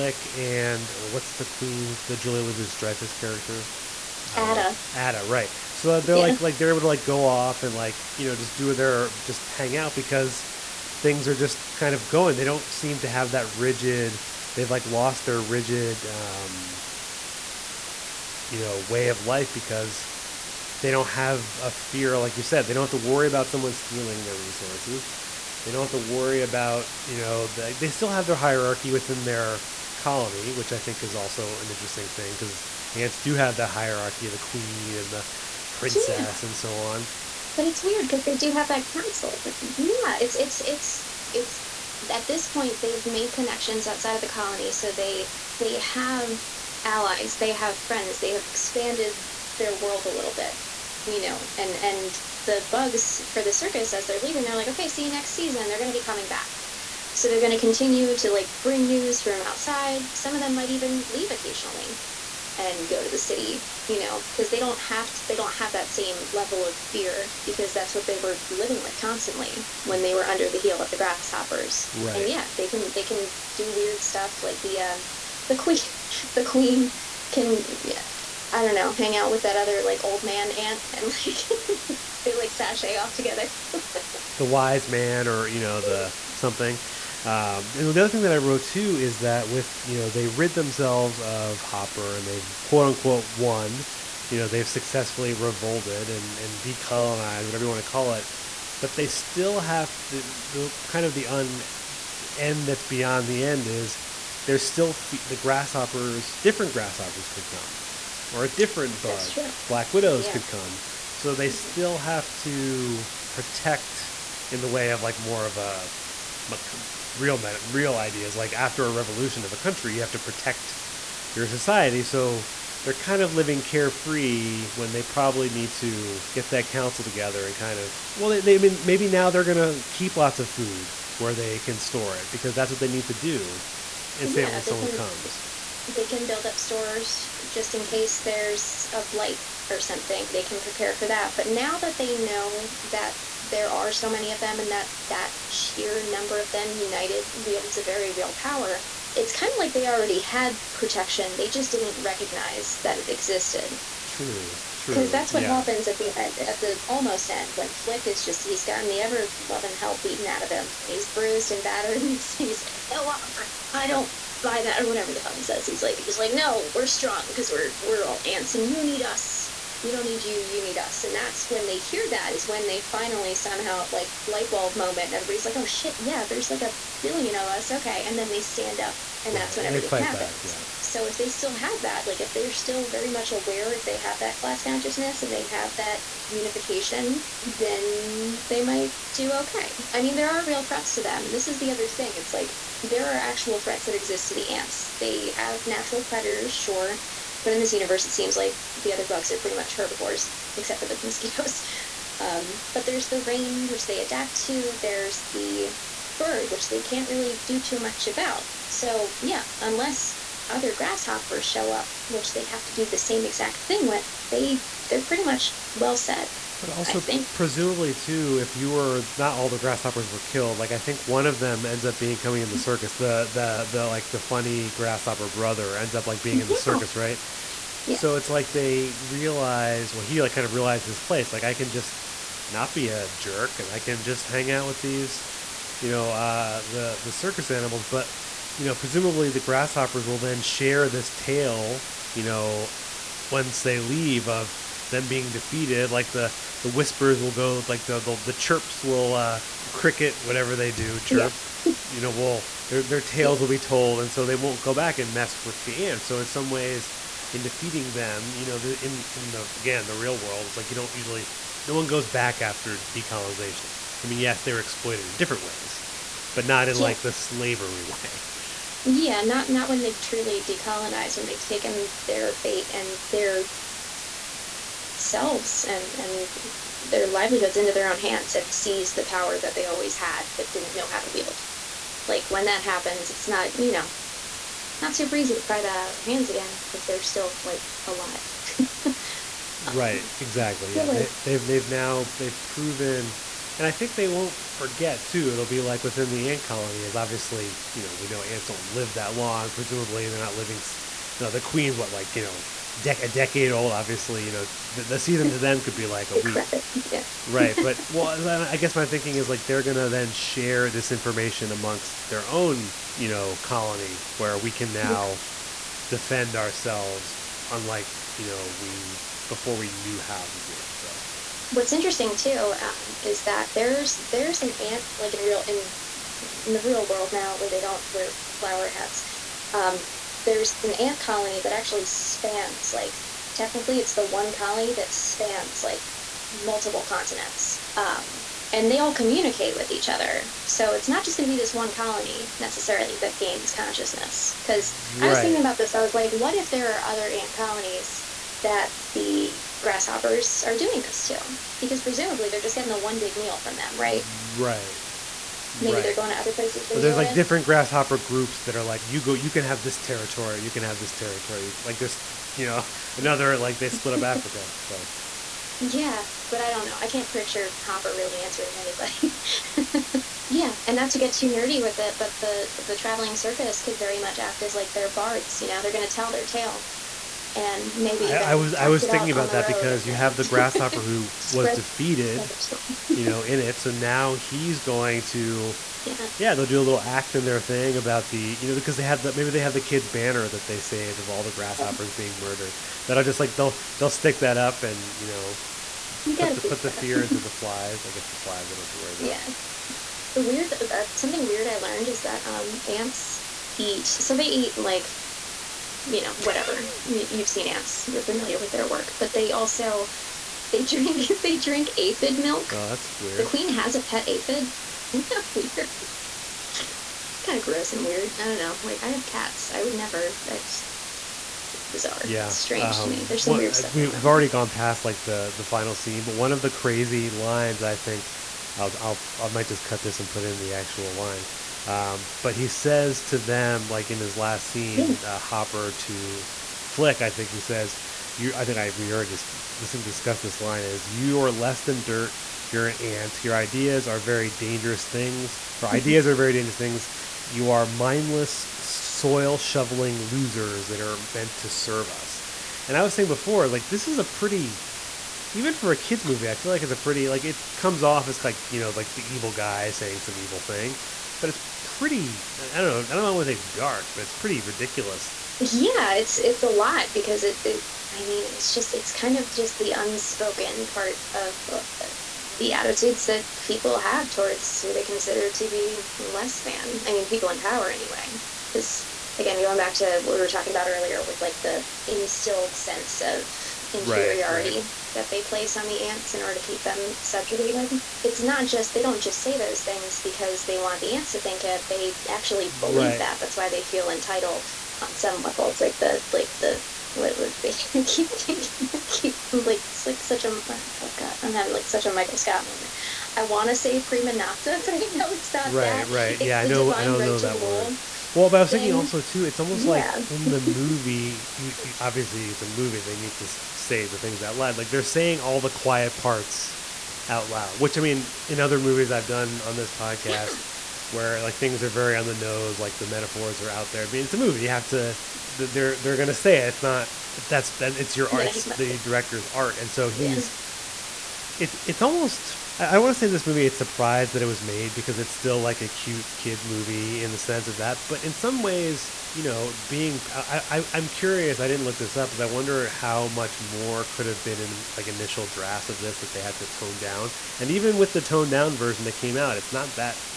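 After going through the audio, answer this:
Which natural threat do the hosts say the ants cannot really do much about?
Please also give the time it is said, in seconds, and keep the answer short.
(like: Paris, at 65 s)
The bird, at 205 s.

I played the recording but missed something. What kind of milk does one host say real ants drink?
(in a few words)
Aphid milk.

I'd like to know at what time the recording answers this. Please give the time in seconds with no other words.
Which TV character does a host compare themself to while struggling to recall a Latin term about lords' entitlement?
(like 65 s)
501 s.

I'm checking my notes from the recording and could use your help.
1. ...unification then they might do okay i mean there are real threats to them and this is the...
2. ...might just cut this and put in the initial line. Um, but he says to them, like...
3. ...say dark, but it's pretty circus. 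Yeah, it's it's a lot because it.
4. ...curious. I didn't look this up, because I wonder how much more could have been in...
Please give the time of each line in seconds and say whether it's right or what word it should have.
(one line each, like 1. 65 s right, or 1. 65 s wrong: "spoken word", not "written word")
1. 186 s right
2. 429 s wrong: "actual", not "initial"
3. 463 s wrong: "ridiculous", not "circus"
4. 540 s right.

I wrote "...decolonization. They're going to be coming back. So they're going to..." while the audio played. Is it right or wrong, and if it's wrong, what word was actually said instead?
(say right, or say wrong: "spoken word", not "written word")
wrong: "season", not "decolonization".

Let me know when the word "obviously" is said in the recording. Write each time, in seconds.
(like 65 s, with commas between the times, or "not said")
296 s, 303 s, 511 s.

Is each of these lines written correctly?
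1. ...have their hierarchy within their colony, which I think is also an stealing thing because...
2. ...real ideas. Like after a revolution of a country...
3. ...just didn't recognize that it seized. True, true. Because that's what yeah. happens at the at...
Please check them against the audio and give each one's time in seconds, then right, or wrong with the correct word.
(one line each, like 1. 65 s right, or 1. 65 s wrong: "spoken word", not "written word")
1. 28 s wrong: "interesting", not "stealing"
2. 117 s right
3. 151 s wrong: "existed", not "seized".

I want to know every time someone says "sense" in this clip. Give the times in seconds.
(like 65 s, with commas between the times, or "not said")
482 s, 537 s.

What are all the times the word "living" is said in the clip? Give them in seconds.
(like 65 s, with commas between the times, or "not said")
68 s, 123 s, 300 s.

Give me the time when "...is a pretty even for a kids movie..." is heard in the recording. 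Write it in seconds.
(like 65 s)
453 s.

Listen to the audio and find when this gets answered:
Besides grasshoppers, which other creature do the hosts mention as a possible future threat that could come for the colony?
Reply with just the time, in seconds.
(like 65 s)
109 s.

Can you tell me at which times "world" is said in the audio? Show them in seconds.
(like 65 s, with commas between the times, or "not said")
49 s, 260 s, 326 s.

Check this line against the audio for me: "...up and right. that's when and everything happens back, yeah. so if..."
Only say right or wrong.
right.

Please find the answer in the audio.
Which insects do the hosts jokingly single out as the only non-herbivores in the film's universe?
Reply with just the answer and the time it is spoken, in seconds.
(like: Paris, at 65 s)
Mosquitoes, at 201 s.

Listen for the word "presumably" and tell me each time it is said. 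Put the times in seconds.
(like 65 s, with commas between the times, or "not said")
217 s, 238 s, 299 s, 351 s.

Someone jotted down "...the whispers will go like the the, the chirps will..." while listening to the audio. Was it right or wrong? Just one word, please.
right.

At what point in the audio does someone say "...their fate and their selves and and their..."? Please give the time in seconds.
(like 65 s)
272 s.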